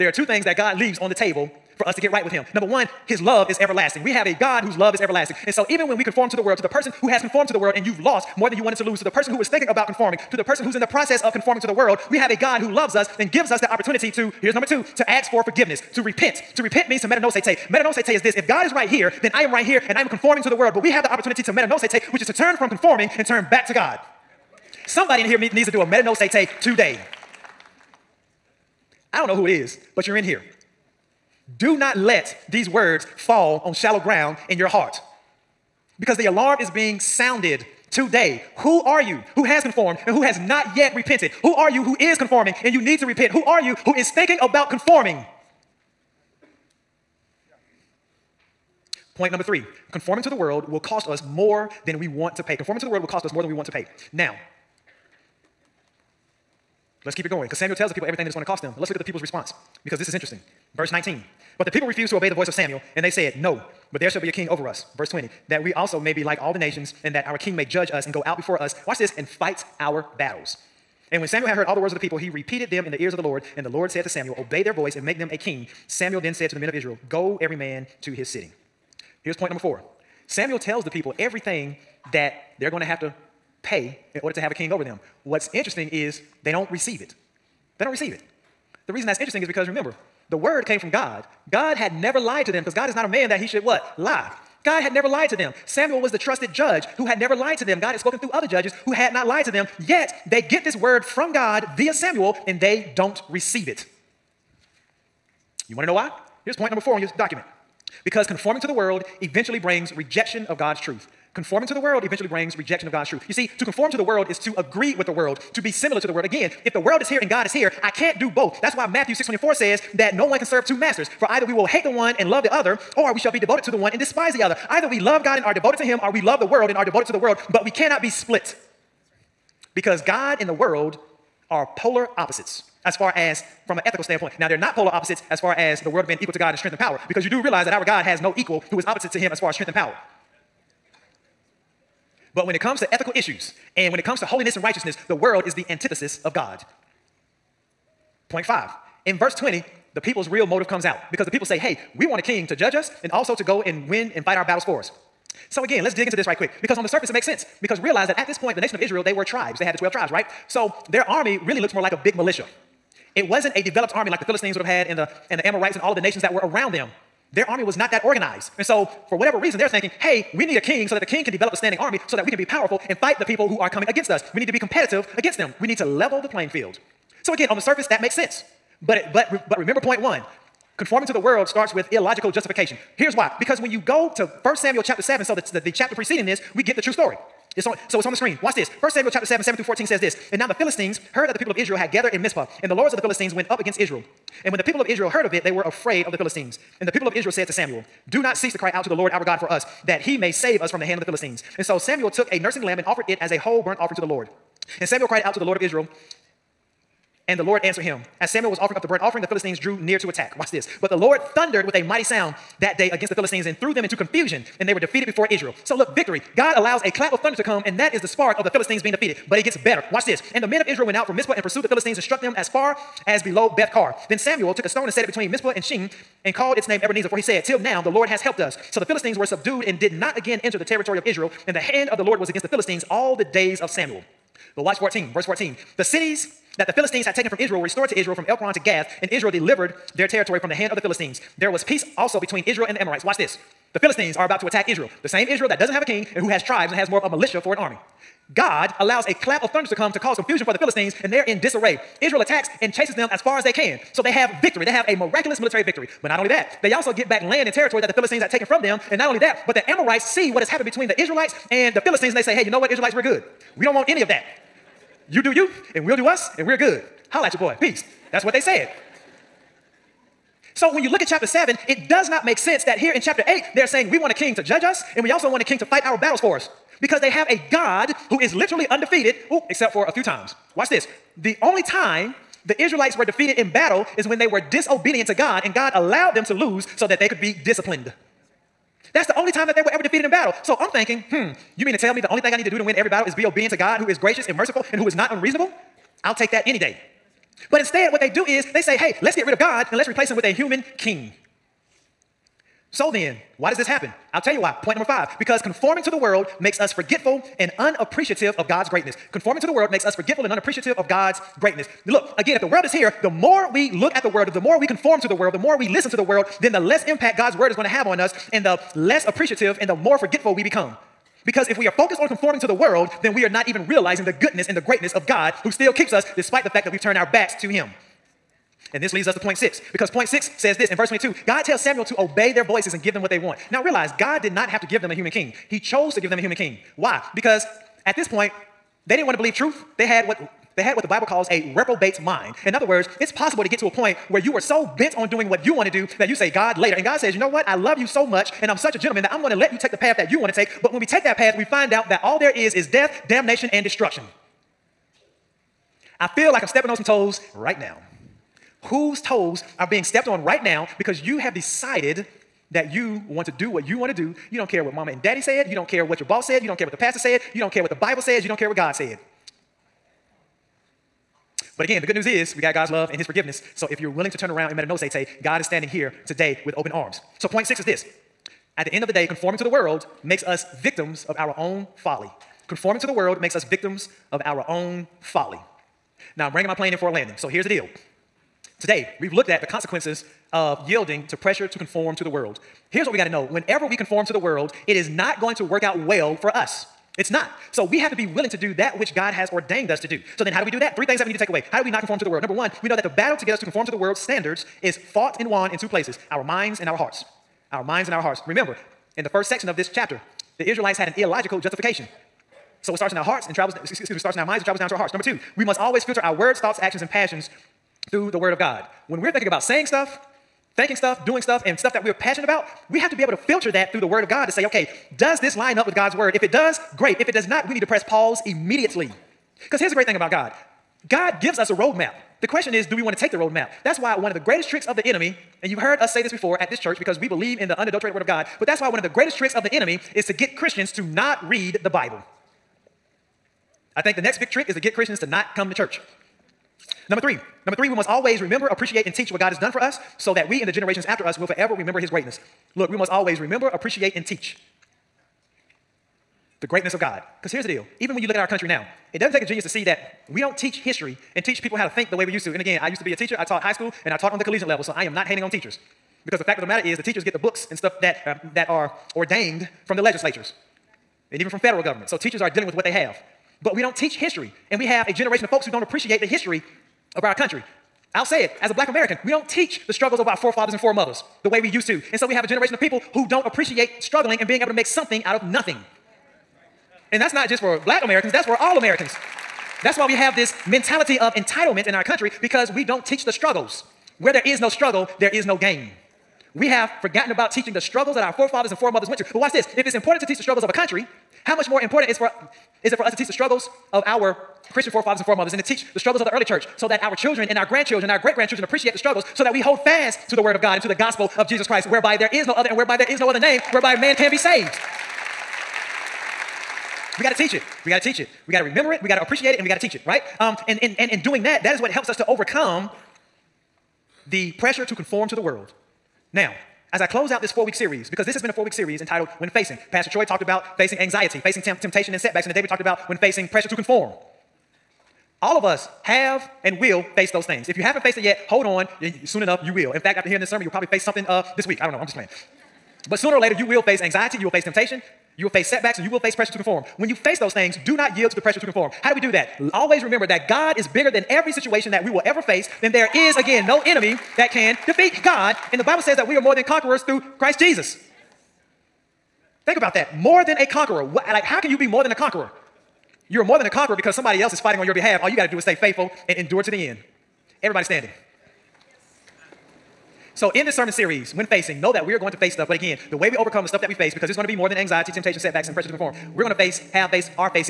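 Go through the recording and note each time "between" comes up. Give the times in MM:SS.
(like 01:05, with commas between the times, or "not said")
03:45, 04:02, 04:20.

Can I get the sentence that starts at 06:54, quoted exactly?
Number two, we must always filter our words, thoughts, actions, and passions through the Word of God.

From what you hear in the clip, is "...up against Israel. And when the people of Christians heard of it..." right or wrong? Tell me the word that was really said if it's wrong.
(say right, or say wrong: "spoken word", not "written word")
wrong: "Israel", not "Christians".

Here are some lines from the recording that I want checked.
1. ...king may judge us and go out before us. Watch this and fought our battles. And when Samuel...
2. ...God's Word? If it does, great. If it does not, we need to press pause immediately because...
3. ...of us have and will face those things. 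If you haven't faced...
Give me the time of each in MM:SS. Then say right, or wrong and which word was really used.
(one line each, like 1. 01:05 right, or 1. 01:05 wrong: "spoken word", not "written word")
1. 01:07 wrong: "fight", not "fought"
2. 07:05 right
3. 08:55 right.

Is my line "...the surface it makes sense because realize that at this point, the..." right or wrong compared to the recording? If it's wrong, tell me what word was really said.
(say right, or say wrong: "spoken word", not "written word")
right.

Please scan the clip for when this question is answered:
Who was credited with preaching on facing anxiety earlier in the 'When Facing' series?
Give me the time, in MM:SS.
08:49.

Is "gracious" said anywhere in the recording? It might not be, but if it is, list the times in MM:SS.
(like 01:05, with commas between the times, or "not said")
04:53.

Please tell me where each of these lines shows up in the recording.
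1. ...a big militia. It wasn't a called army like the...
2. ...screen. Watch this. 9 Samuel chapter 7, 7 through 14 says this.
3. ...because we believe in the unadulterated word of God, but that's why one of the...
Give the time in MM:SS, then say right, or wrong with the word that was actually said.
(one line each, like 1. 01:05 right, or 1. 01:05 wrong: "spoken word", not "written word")
1. 02:41 wrong: "developed", not "called"
2. 03:08 wrong: "1", not "9"
3. 07:16 right.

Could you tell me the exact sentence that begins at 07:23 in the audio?
I think the next big trick is to get Christians to not come to church.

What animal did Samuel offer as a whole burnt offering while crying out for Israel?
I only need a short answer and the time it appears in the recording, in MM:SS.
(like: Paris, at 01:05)
a nursing lamb, at 03:22.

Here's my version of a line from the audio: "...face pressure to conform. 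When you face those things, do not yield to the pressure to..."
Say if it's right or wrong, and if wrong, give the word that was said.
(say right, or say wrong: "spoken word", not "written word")
right.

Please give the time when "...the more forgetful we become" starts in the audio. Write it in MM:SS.
05:19.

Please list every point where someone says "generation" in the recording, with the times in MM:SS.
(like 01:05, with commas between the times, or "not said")
07:30, 07:54, 08:02.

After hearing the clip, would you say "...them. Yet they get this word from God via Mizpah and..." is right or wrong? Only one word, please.
wrong.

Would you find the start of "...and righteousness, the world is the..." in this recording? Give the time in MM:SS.
02:24.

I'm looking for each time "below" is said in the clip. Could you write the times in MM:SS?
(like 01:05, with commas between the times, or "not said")
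03:43.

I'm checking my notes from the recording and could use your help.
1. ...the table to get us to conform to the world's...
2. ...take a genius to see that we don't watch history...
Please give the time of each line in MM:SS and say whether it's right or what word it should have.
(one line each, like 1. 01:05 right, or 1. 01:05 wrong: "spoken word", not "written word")
1. 06:42 wrong: "battle", not "table"
2. 07:39 wrong: "teach", not "watch".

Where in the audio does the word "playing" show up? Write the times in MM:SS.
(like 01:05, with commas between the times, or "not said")
02:56, 09:01.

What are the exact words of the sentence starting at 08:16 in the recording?
We have forgotten about teaching the struggles that our forefathers and foremothers went to.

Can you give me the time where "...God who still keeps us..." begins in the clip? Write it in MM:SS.
05:25.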